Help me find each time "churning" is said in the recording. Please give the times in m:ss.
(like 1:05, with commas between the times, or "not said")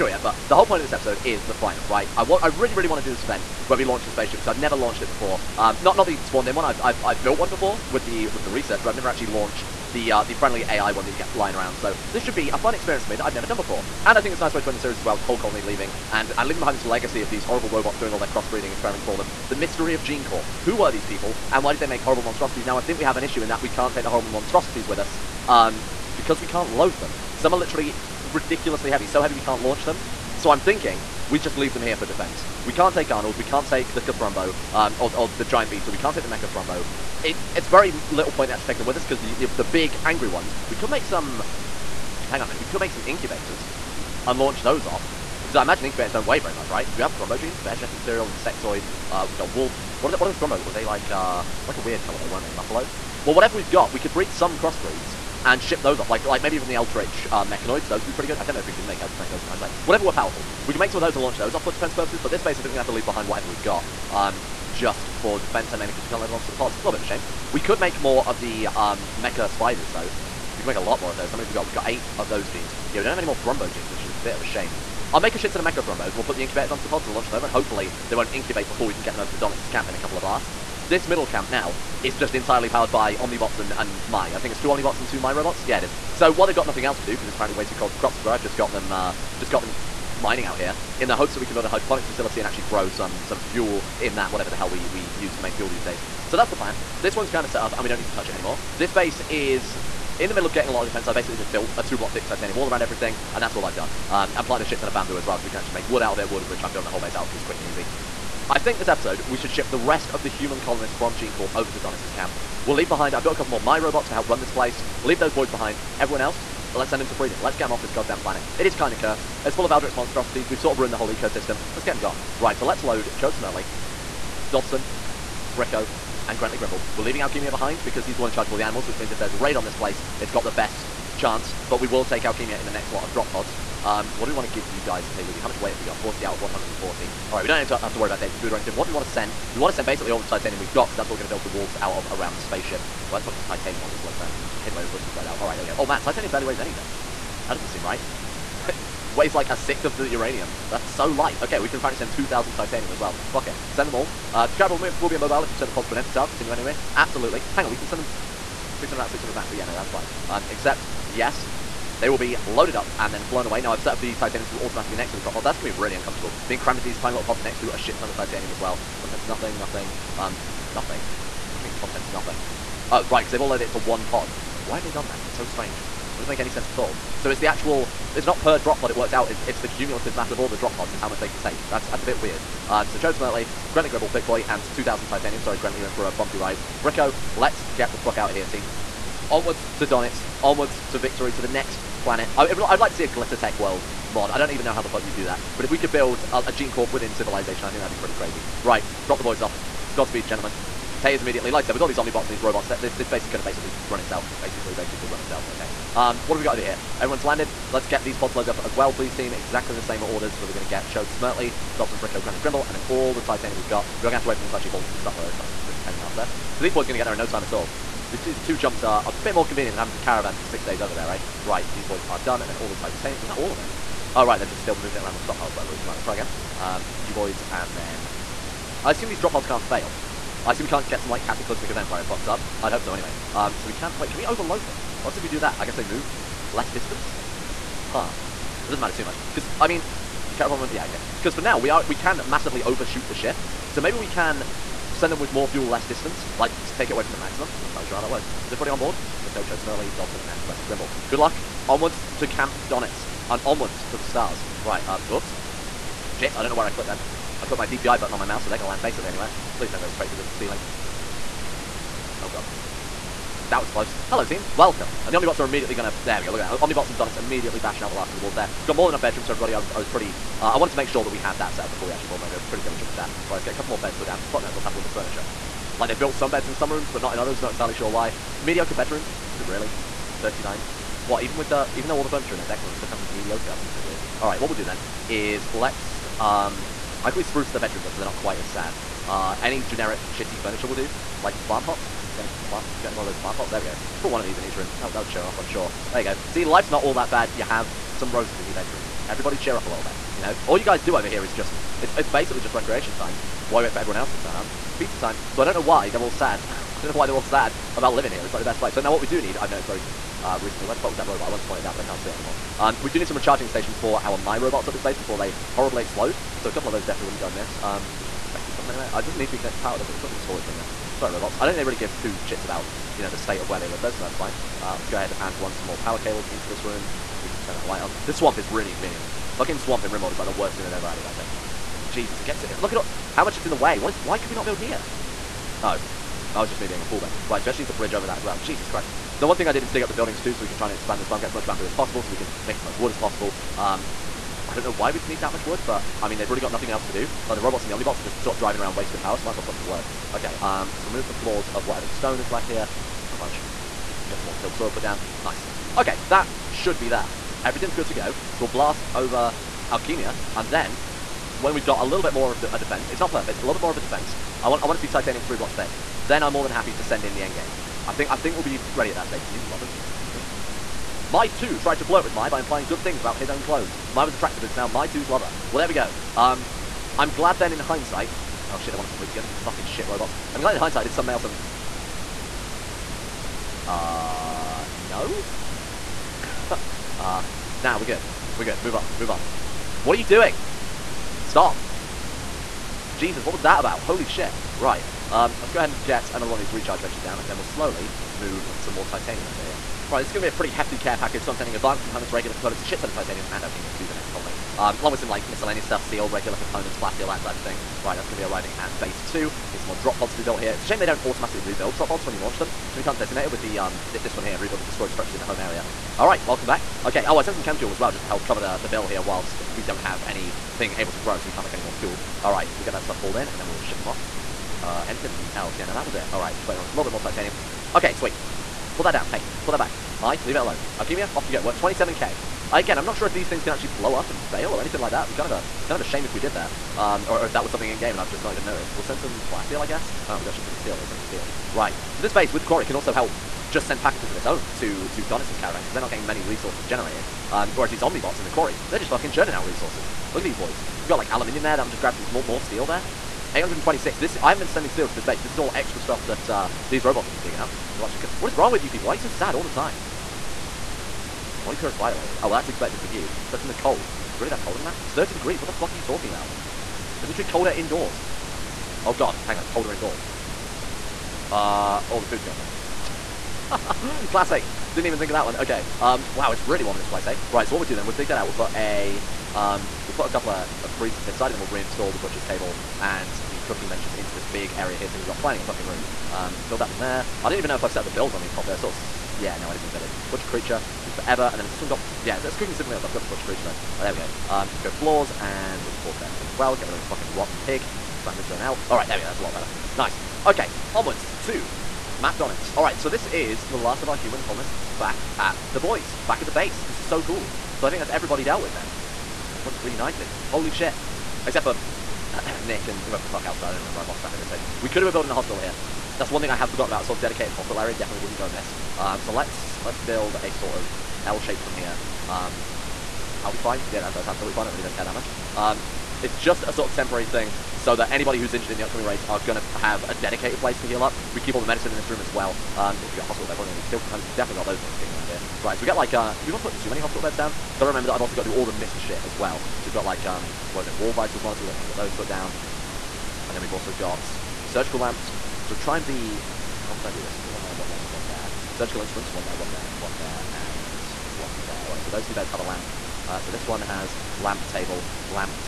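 7:29.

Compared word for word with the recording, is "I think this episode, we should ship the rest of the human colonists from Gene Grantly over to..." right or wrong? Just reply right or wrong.
wrong.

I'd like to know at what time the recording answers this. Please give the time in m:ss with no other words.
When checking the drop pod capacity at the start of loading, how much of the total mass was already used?
2:15.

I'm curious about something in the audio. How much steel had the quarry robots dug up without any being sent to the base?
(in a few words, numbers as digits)
826.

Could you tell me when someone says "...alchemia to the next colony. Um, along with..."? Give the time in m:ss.
6:43.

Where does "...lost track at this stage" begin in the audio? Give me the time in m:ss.
8:33.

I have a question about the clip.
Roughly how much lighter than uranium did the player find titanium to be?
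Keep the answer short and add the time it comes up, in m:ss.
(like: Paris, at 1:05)
a sixth, at 2:29.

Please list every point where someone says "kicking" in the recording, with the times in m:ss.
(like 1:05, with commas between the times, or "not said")
8:54.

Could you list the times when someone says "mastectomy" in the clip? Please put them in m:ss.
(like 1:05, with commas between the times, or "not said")
not said.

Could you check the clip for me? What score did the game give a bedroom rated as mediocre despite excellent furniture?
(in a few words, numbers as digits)
39.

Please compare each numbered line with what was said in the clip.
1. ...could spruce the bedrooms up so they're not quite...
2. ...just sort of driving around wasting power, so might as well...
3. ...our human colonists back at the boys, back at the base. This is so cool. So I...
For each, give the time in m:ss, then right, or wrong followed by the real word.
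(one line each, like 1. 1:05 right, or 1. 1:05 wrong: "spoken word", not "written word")
1. 4:47 right
2. 5:48 right
3. 8:23 right.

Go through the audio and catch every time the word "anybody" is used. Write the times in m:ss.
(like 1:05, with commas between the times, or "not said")
8:47.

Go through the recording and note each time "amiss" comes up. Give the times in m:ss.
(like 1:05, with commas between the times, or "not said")
5:17, 8:38.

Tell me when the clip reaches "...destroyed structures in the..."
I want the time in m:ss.
6:54.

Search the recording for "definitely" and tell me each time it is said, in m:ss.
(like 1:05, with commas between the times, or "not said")
5:16, 8:37, 8:54.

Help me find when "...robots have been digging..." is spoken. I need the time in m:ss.
7:36.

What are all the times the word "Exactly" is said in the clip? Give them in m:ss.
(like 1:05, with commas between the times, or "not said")
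3:29.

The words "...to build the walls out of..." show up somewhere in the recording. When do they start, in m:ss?
2:21.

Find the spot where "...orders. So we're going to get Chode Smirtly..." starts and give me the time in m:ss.
3:30.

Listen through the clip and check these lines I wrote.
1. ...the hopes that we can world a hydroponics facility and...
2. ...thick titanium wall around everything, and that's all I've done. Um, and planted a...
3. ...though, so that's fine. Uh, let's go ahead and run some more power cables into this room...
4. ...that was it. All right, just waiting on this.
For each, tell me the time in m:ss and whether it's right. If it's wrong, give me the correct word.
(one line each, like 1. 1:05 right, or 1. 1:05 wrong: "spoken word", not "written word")
1. 1:31 wrong: "build", not "world"
2. 1:42 right
3. 5:23 right
4. 7:05 right.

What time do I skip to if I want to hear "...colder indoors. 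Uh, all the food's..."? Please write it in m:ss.
7:49.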